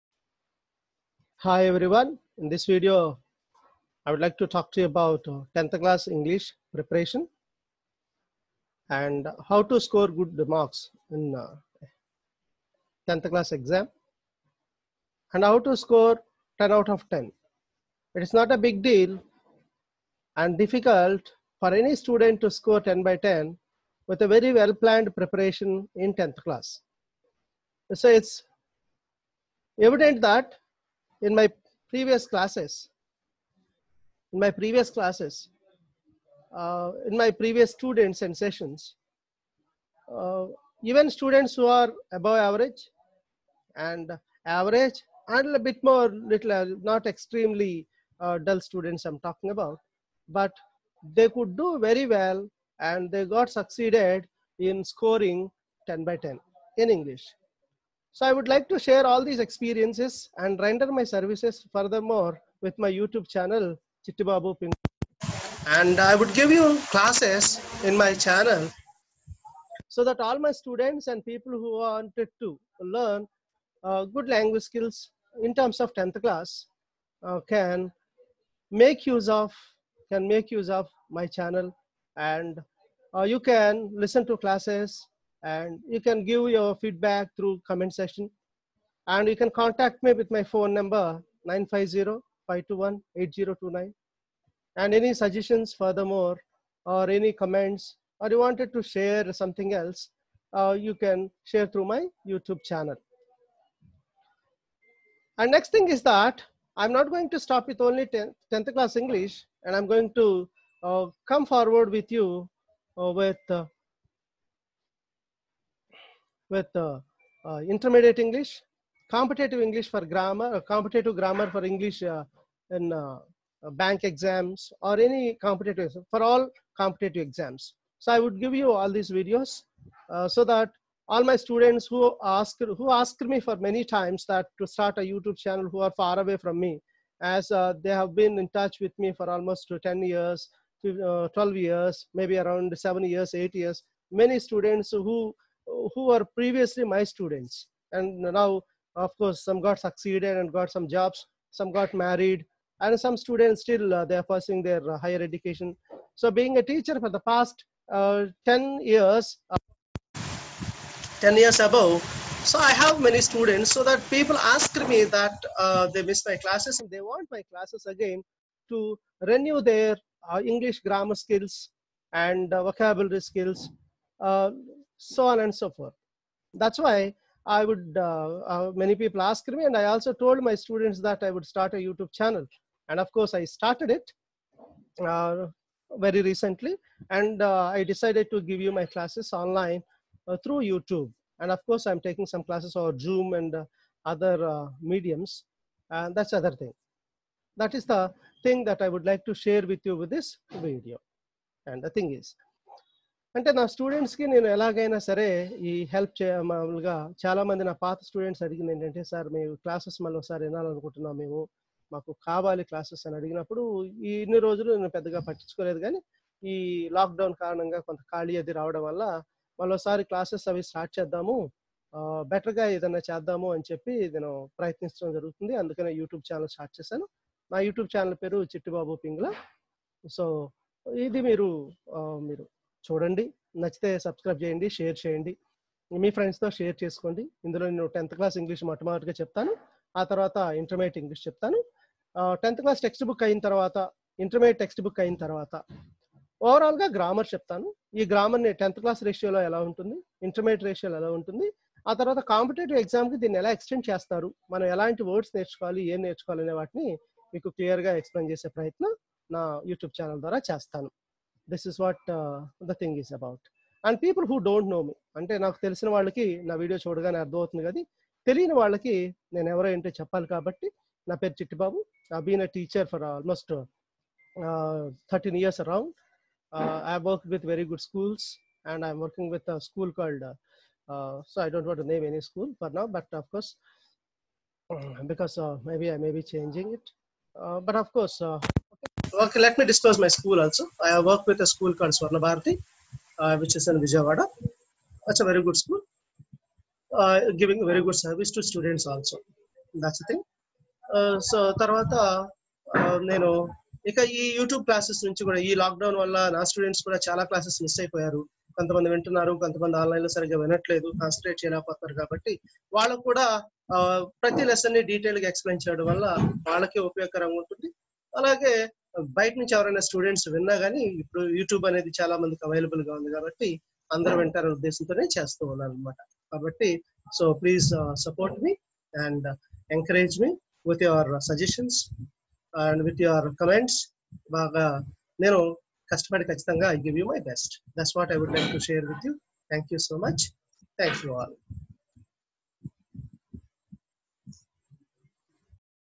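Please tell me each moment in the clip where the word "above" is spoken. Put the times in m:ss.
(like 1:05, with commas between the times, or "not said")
0:42, 2:41.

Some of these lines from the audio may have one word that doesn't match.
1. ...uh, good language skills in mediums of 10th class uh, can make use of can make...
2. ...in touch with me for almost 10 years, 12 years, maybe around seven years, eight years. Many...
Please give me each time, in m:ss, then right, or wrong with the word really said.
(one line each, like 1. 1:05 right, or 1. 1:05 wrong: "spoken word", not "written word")
1. 1:13 wrong: "terms", not "mediums"
2. 2:18 right.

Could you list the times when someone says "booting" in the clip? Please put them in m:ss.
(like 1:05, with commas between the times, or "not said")
not said.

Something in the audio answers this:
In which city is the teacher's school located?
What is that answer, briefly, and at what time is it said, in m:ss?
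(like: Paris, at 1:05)
Vijayawada, at 4:53.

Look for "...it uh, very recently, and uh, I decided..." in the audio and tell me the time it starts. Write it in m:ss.
3:03.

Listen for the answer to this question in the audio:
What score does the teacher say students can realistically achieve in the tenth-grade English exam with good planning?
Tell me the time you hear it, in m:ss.
0:16.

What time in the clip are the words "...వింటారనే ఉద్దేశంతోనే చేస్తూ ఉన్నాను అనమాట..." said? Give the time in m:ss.
5:24.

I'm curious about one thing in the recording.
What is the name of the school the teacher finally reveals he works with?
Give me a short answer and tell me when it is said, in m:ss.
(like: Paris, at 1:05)
Swarna Bharati, at 4:51.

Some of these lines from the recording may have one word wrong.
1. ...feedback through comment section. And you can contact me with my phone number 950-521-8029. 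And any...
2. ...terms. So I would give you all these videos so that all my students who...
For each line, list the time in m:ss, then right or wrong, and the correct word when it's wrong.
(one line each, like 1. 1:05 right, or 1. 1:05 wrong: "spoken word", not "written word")
1. 1:26 right
2. 2:07 wrong: "exams", not "terms".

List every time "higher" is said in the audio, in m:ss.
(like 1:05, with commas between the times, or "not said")
2:34.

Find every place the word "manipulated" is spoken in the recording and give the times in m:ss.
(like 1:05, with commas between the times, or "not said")
not said.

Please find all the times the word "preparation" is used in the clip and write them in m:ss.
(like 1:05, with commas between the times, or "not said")
0:06, 0:25.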